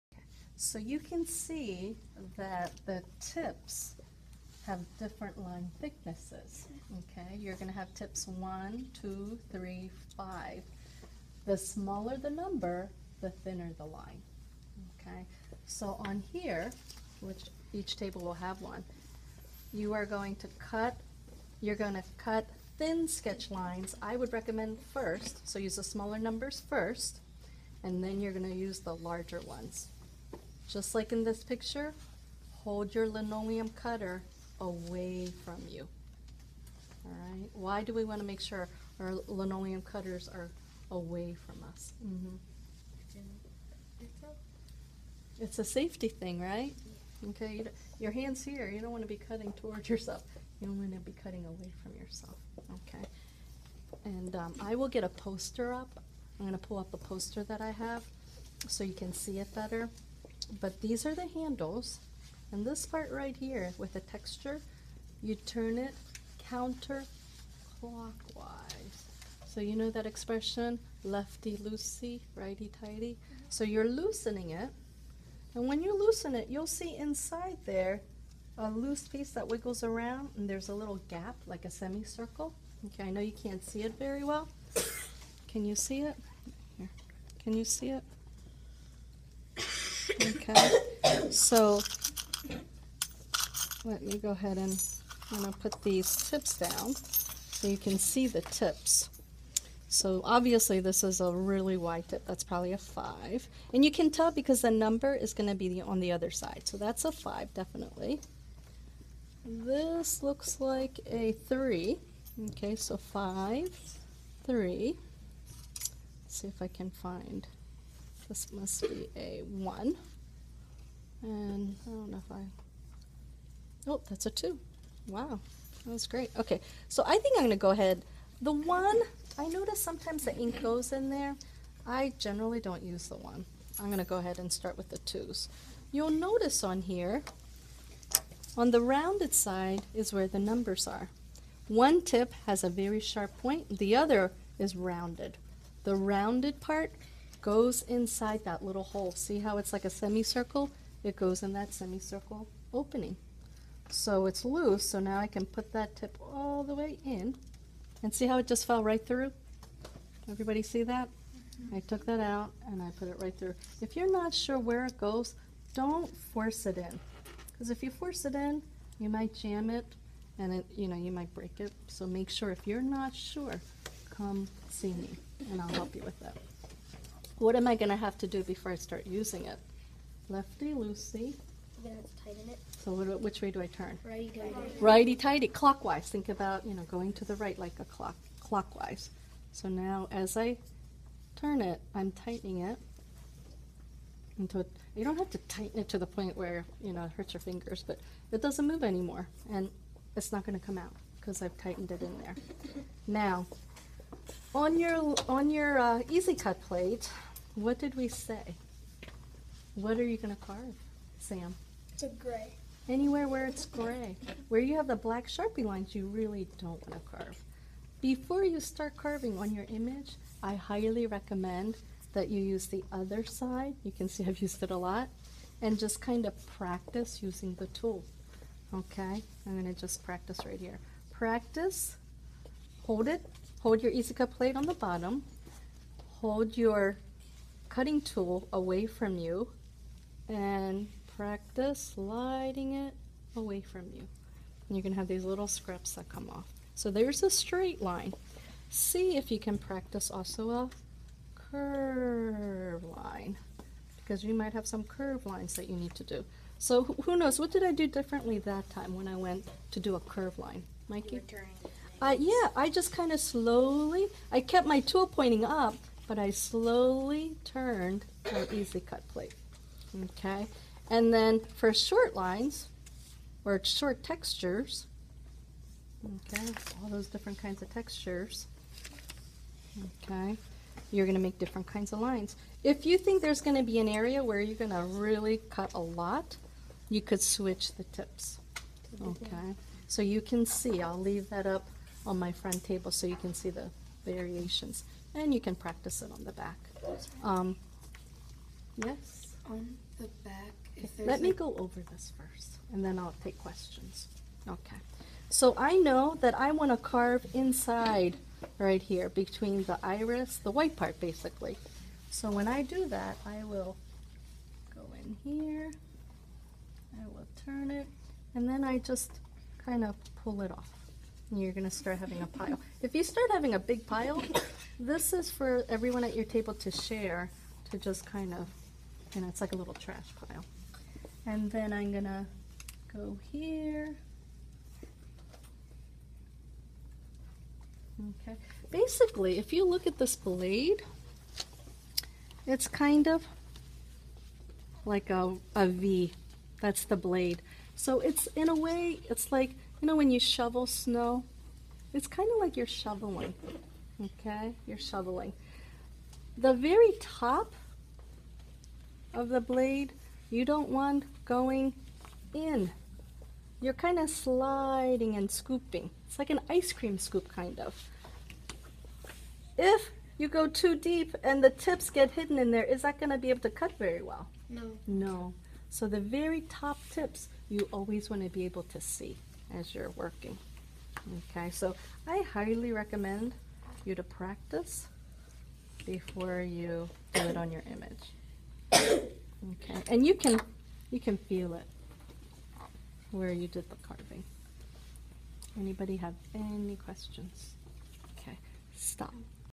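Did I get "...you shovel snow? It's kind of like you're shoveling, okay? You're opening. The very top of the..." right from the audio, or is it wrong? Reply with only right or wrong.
wrong.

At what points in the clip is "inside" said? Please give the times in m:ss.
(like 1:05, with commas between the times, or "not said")
1:16, 2:27, 5:07.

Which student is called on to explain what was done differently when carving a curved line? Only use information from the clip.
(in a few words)
Mikey.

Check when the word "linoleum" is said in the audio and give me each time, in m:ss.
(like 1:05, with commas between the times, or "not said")
0:33, 0:39.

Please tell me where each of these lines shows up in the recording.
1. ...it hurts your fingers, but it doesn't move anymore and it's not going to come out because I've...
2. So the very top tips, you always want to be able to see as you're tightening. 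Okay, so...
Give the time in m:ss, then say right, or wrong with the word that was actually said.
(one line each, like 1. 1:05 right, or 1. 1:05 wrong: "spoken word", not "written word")
1. 3:17 right
2. 6:15 wrong: "working", not "tightening".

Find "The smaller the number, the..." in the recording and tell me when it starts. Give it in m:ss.
0:11.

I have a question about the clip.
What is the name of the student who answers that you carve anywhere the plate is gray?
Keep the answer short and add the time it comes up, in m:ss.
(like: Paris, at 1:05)
Sam, at 3:31.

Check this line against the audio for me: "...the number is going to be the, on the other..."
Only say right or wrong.
right.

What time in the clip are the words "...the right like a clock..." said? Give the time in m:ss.
3:07.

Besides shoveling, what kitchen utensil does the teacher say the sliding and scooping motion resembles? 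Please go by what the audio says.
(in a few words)
Ice cream scoop.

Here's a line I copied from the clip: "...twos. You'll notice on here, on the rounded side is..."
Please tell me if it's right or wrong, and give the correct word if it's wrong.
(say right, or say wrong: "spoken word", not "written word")
right.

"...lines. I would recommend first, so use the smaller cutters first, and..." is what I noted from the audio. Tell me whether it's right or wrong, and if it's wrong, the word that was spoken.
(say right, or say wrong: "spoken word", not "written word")
wrong: "numbers", not "cutters".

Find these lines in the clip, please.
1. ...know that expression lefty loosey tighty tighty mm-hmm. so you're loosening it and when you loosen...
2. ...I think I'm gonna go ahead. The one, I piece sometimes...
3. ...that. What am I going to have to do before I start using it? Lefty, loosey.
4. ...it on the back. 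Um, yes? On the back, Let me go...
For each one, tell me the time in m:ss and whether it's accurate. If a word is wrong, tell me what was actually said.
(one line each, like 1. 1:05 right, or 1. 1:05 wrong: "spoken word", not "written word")
1. 1:09 wrong: "righty", not "tighty"
2. 2:07 wrong: "notice", not "piece"
3. 2:56 right
4. 4:56 right.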